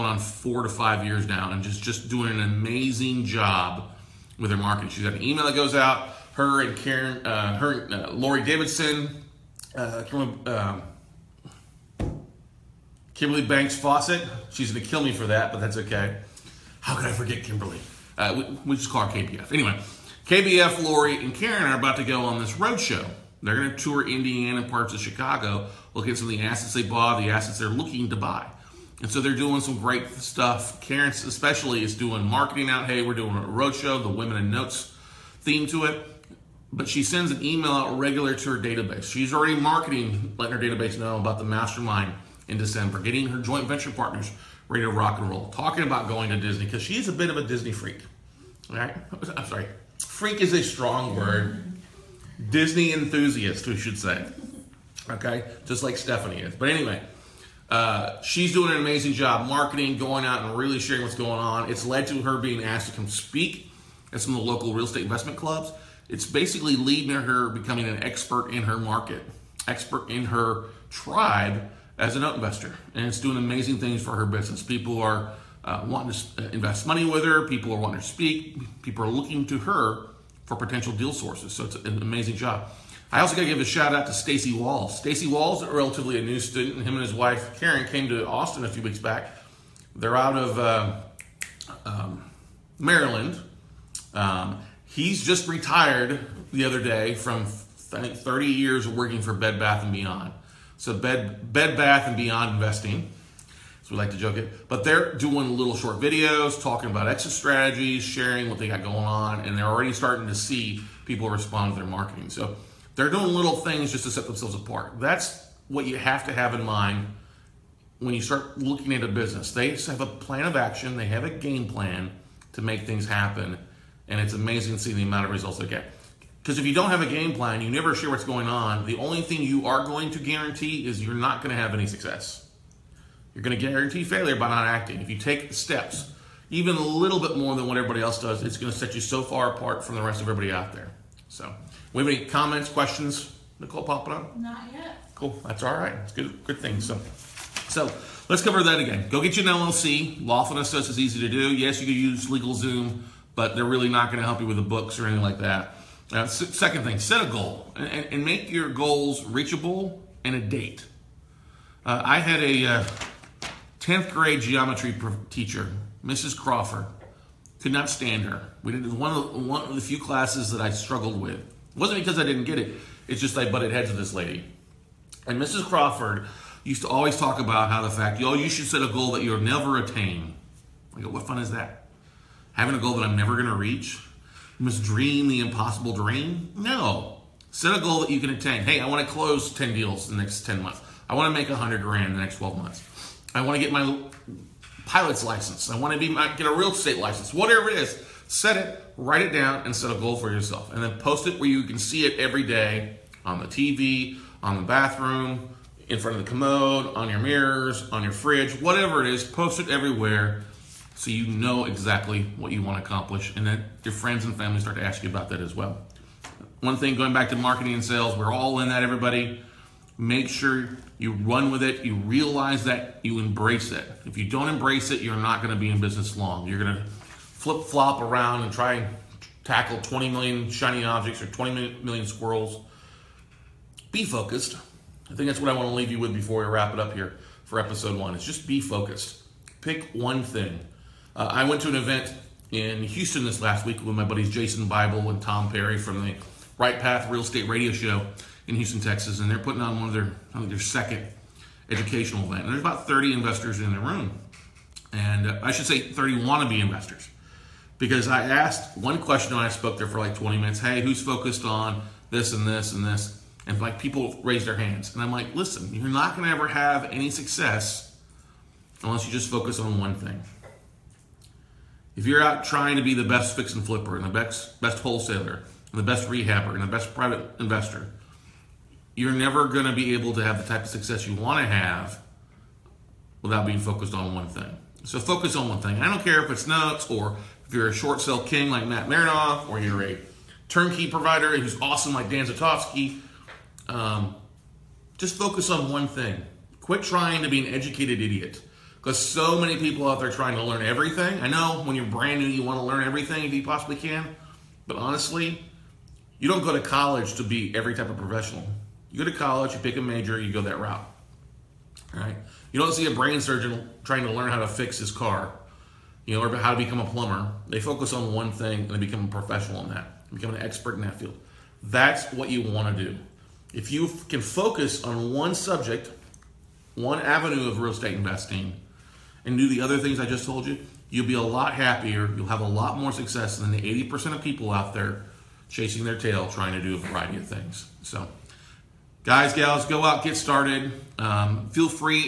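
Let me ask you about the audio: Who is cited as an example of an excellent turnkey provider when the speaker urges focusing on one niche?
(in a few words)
Dan Zatofsky.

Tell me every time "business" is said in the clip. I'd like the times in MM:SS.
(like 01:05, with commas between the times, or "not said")
01:14, 01:59, 03:45.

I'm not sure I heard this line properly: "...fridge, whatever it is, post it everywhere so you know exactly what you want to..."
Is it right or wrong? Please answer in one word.
right.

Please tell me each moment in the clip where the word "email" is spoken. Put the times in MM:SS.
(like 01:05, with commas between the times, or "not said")
00:05, 00:37.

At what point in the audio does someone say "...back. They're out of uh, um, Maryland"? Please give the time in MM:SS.
01:28.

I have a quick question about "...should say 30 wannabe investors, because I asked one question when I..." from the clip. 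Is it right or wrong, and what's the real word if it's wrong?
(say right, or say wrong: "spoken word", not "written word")
right.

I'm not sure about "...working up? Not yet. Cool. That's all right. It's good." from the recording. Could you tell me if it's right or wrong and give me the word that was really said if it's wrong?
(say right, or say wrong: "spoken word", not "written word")
wrong: "popping", not "working".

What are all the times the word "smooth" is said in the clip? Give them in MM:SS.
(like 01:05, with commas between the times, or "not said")
not said.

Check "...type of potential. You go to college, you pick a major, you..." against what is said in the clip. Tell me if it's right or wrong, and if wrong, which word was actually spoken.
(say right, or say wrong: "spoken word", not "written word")
wrong: "professional", not "potential".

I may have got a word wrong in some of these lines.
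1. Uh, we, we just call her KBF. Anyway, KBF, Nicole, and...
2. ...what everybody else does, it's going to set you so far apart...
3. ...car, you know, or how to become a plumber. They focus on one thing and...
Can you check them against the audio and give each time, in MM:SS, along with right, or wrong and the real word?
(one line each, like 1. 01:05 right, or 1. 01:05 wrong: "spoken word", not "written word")
1. 00:18 wrong: "Lori", not "Nicole"
2. 02:17 right
3. 05:14 right.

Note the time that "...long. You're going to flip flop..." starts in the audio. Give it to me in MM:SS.
03:46.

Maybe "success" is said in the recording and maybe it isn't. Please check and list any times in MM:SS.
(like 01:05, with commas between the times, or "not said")
02:11, 04:27, 04:40, 05:32.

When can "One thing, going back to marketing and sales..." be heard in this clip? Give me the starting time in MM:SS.
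03:36.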